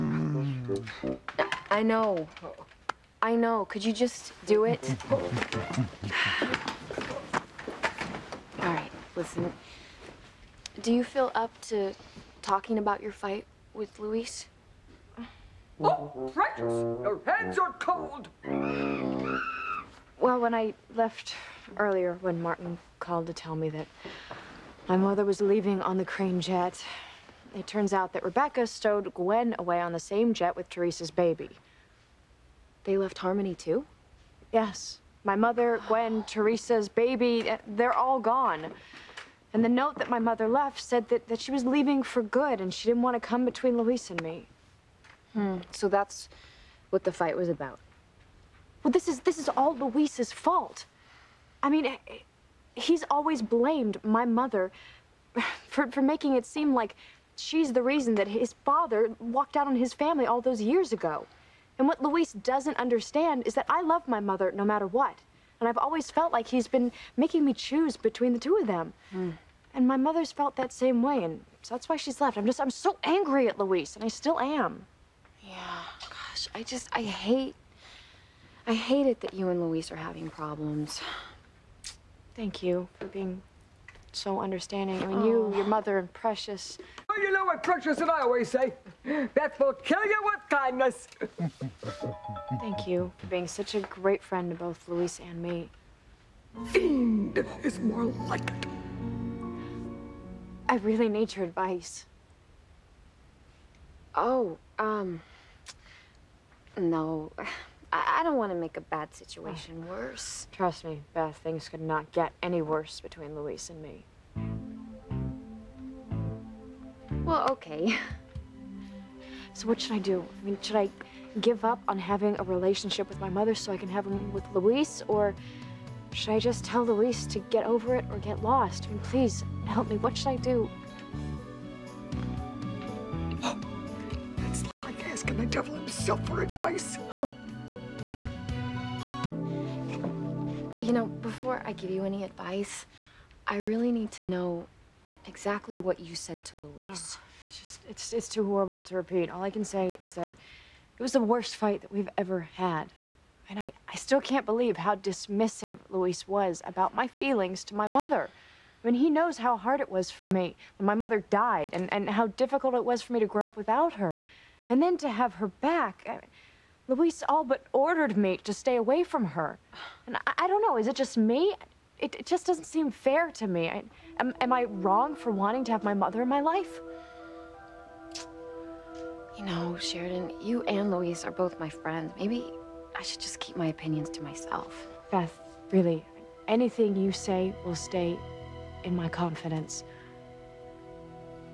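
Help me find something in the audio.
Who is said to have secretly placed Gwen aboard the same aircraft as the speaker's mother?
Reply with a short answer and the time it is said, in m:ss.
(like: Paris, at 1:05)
Rebecca, at 0:28.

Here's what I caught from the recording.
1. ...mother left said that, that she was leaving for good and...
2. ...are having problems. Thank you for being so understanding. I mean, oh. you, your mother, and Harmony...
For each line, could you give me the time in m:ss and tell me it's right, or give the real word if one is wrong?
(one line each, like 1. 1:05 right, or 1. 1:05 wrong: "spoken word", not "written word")
1. 0:40 right
2. 1:19 wrong: "Precious", not "Harmony".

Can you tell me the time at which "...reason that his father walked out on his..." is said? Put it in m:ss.
0:57.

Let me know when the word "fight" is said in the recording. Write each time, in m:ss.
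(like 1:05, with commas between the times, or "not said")
0:13, 0:47, 2:31.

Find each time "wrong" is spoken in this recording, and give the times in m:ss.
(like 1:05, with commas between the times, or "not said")
2:54.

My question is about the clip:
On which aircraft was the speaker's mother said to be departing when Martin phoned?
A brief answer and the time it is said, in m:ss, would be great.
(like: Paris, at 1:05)
The crane jet, at 0:26.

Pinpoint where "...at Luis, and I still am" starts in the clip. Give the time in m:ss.
1:13.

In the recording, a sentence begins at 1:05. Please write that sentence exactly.
And I've always felt like he's been making me choose between the two of them.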